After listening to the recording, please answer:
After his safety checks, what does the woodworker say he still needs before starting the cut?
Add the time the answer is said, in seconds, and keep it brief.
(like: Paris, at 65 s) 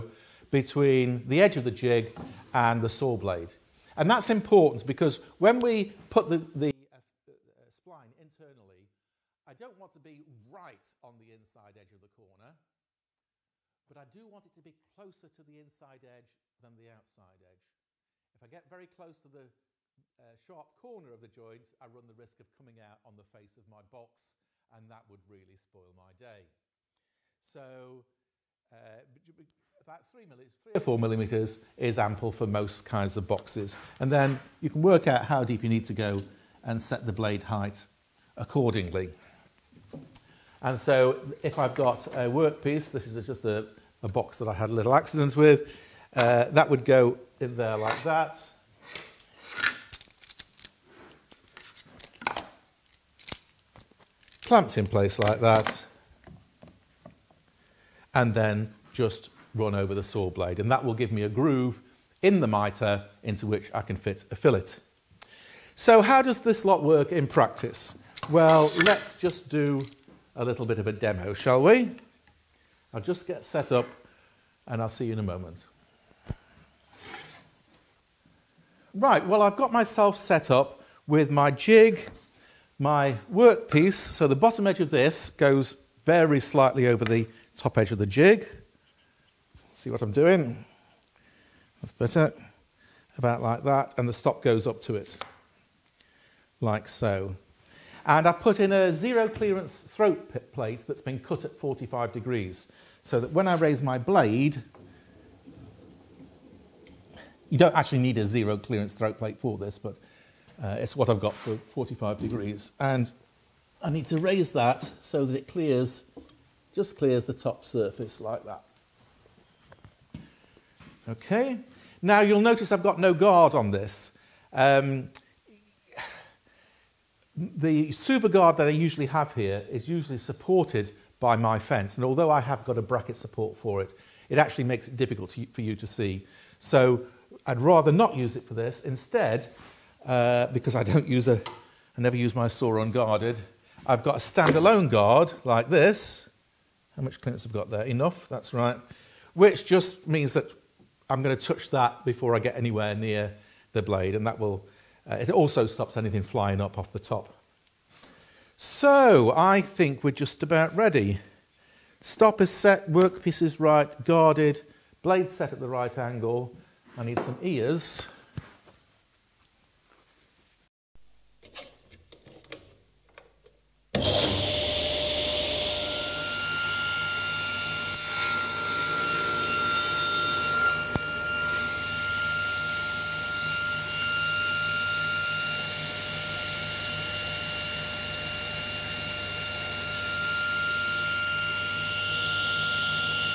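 Some ears, at 167 s.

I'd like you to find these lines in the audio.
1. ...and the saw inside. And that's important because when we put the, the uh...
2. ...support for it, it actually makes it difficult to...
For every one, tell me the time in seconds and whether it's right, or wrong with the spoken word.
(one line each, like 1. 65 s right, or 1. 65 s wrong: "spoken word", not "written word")
1. 2 s wrong: "blade", not "inside"
2. 133 s right.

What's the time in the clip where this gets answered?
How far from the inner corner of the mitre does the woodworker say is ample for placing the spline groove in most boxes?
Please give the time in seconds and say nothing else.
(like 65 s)
30 s.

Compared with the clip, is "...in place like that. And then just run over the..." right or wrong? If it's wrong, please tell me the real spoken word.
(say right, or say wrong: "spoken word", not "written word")
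right.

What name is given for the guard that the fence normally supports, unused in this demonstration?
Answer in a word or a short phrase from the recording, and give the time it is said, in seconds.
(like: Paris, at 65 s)
Suva, at 127 s.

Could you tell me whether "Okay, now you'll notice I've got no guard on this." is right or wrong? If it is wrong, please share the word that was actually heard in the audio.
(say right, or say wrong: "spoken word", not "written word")
right.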